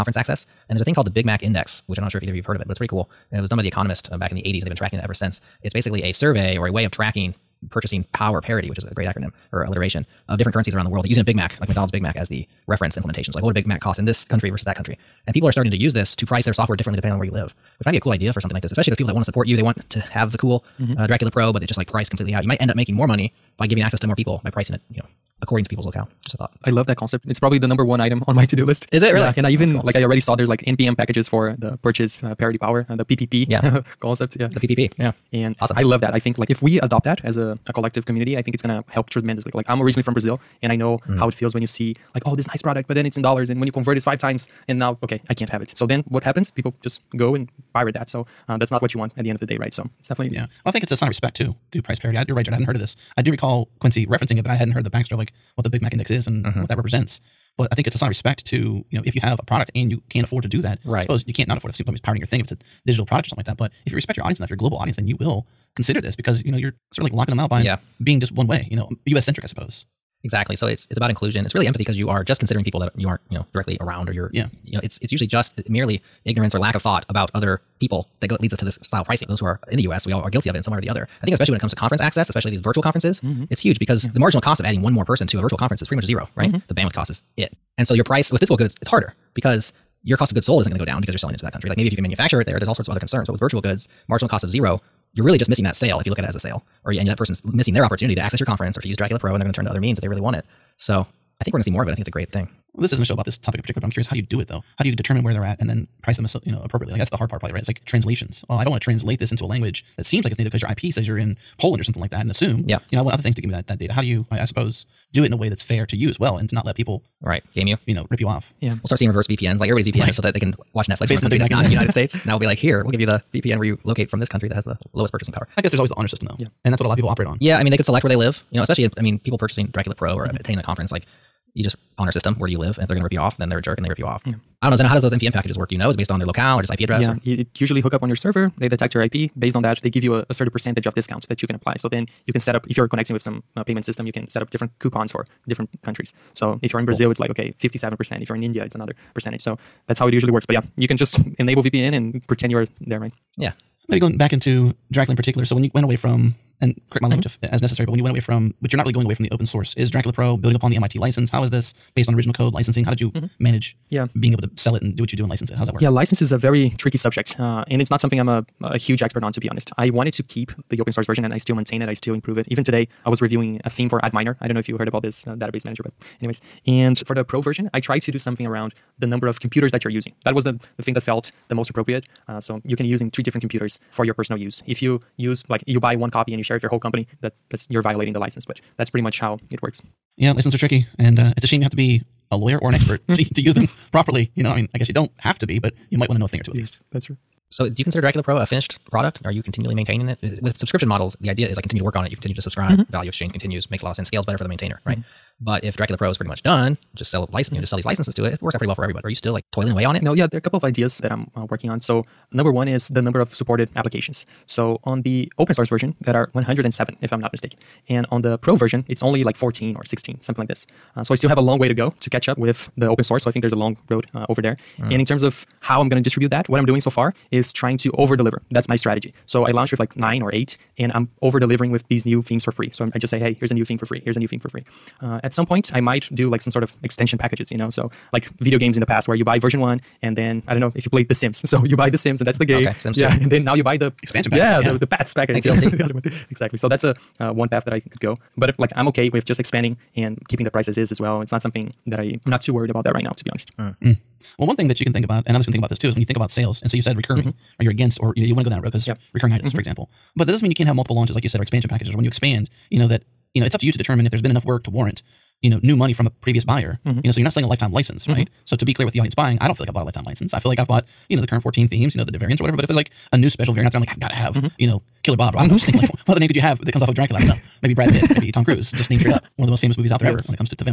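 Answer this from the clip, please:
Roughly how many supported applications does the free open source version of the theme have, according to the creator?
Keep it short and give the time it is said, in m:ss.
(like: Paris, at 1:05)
107, at 3:36.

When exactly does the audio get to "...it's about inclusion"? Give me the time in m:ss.
1:10.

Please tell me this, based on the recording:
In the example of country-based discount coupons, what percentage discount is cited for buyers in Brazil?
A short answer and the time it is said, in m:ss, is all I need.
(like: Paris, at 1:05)
57%, at 2:27.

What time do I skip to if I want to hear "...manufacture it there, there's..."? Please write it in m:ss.
1:32.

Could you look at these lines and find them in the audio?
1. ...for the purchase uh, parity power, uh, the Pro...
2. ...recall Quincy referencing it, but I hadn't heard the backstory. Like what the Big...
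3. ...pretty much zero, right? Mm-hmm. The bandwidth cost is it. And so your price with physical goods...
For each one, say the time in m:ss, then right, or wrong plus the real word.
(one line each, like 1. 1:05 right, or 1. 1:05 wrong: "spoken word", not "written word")
1. 0:31 wrong: "PPP", not "Pro"
2. 0:53 right
3. 1:25 right.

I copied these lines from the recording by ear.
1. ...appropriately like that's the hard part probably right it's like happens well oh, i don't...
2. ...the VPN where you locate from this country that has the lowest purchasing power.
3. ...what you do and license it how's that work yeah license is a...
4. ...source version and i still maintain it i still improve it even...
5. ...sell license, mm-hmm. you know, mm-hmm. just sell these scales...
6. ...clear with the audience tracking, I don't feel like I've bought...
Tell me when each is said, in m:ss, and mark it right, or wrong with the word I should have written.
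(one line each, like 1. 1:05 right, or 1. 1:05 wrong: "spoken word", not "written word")
1. 1:46 wrong: "translations", not "happens"
2. 2:03 right
3. 2:45 right
4. 2:50 right
5. 3:27 wrong: "licenses", not "scales"
6. 4:28 wrong: "buying", not "tracking".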